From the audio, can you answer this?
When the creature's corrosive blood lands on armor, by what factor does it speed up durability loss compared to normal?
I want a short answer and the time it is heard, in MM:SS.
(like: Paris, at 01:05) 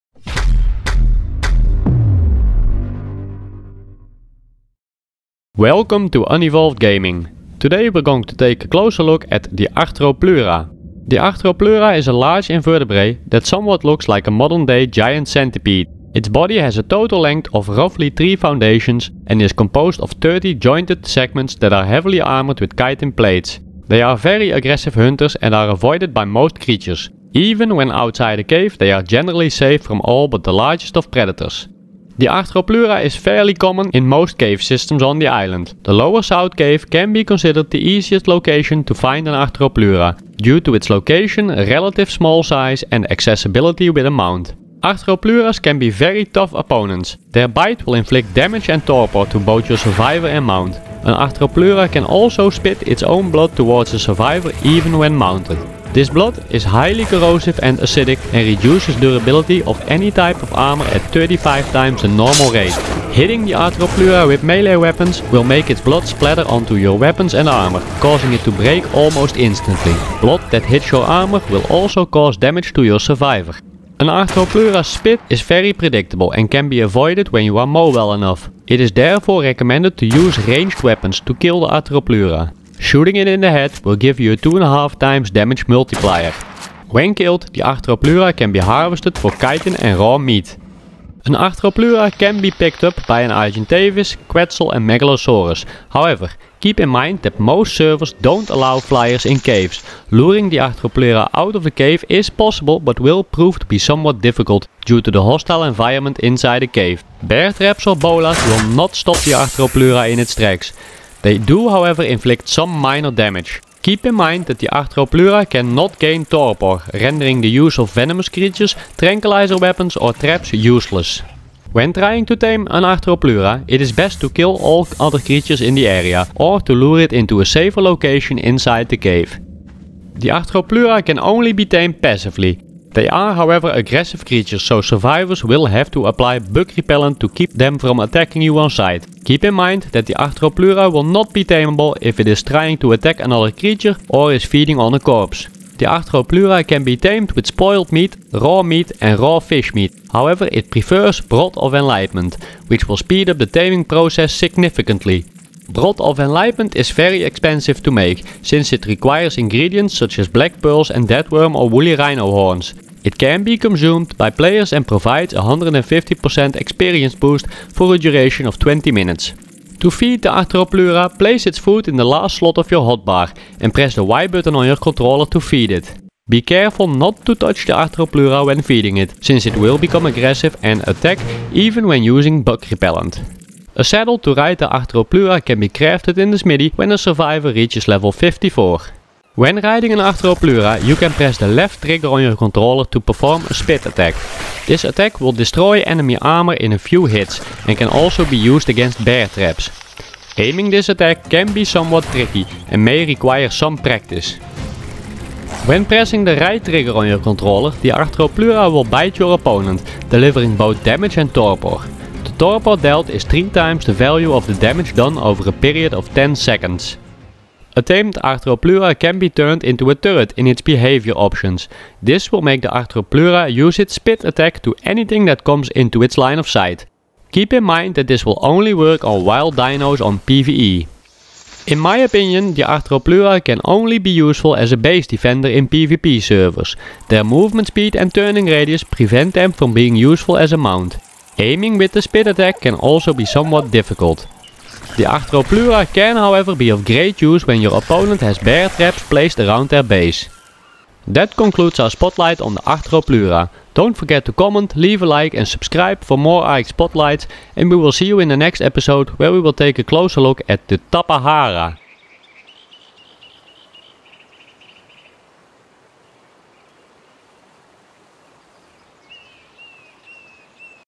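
35 times, at 01:01.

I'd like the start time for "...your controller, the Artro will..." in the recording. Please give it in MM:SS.
03:27.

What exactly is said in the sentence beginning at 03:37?
A tamed Arthropleura can be turned into a turret in its behavior options.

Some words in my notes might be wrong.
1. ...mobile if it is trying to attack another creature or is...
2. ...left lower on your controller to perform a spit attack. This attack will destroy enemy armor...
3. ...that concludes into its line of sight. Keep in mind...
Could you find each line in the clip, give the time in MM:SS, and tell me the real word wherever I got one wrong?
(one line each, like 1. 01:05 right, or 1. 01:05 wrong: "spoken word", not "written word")
1. 02:21 wrong: "tameable", not "mobile"
2. 03:11 wrong: "trigger", not "lower"
3. 03:45 wrong: "comes", not "concludes".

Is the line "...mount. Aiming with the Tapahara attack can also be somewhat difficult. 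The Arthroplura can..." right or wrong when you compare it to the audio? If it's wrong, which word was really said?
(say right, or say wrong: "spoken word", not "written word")
wrong: "Spit", not "Tapahara".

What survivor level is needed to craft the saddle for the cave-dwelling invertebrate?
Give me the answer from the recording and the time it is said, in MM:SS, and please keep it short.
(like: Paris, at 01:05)
54, at 03:07.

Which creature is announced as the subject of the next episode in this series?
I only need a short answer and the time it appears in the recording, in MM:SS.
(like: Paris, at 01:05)
Tapahara, at 04:20.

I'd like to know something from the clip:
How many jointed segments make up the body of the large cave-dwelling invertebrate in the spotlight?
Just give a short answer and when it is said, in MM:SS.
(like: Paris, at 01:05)
30, at 00:20.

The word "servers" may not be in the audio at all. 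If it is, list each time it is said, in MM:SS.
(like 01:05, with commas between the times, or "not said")
01:37, 03:56.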